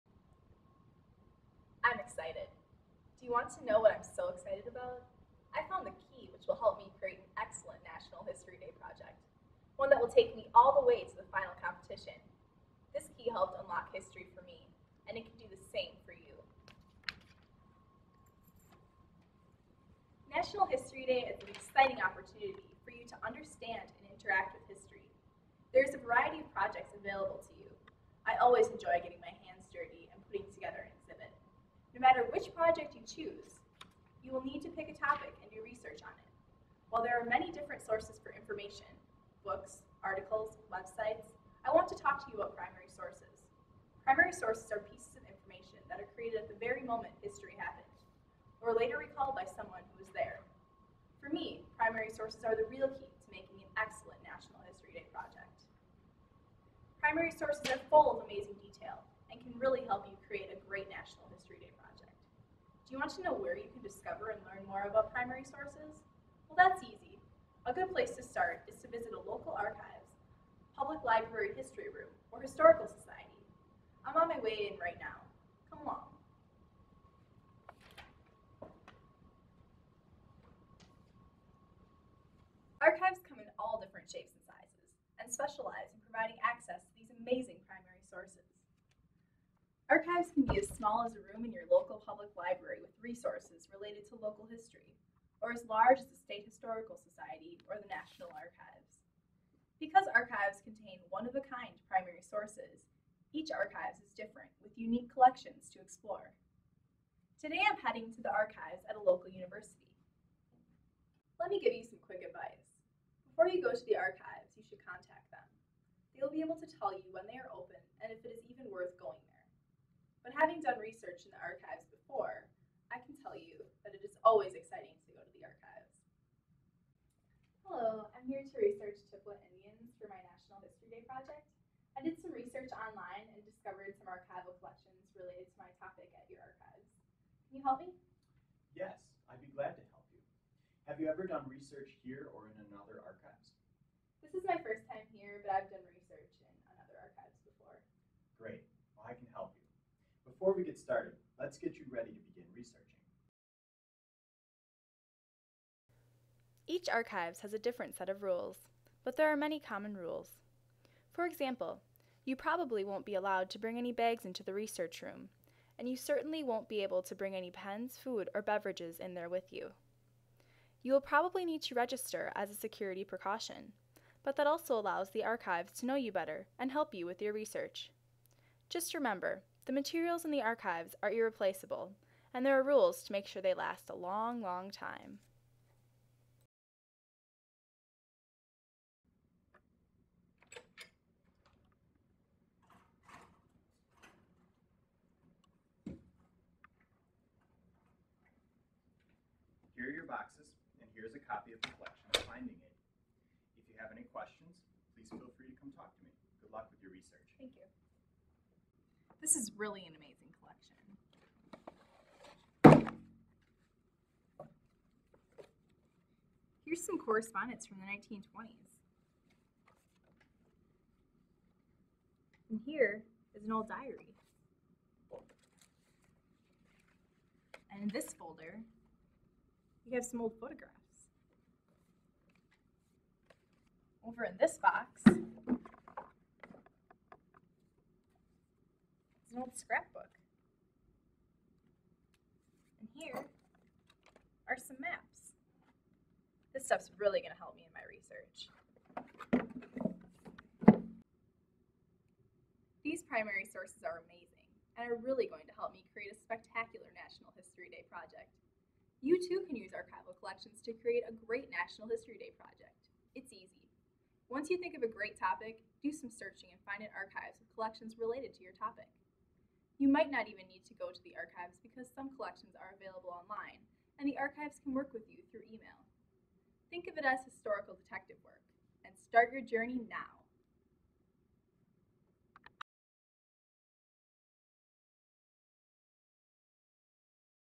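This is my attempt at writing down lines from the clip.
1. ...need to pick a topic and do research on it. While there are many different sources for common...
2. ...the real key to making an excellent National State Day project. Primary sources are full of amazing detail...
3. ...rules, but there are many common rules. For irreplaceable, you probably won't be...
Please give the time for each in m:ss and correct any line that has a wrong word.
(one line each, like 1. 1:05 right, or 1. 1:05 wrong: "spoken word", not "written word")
1. 0:34 wrong: "information", not "common"
2. 0:52 wrong: "History", not "State"
3. 2:38 wrong: "example", not "irreplaceable".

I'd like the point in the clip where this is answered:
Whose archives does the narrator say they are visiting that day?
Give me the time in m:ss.
1:48.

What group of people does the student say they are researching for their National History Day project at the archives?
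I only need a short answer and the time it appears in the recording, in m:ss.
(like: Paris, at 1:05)
Chippewa Indians, at 2:09.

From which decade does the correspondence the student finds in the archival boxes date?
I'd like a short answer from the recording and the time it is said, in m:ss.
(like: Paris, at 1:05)
1920s, at 3:37.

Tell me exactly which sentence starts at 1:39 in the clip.
Because archives contain one of a kind primary sources, each archives is different with unique collections to explore.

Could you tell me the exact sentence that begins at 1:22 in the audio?
Archives come in all different shapes and sizes and specialize in providing access to these amazing primary sources.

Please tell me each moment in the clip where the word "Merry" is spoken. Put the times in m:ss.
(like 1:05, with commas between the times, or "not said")
not said.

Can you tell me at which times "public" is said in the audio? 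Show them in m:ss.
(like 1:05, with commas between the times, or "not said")
1:10, 1:32.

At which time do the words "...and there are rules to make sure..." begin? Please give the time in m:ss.
3:02.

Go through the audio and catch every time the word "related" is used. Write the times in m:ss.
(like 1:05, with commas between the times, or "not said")
1:33, 2:15, 4:27.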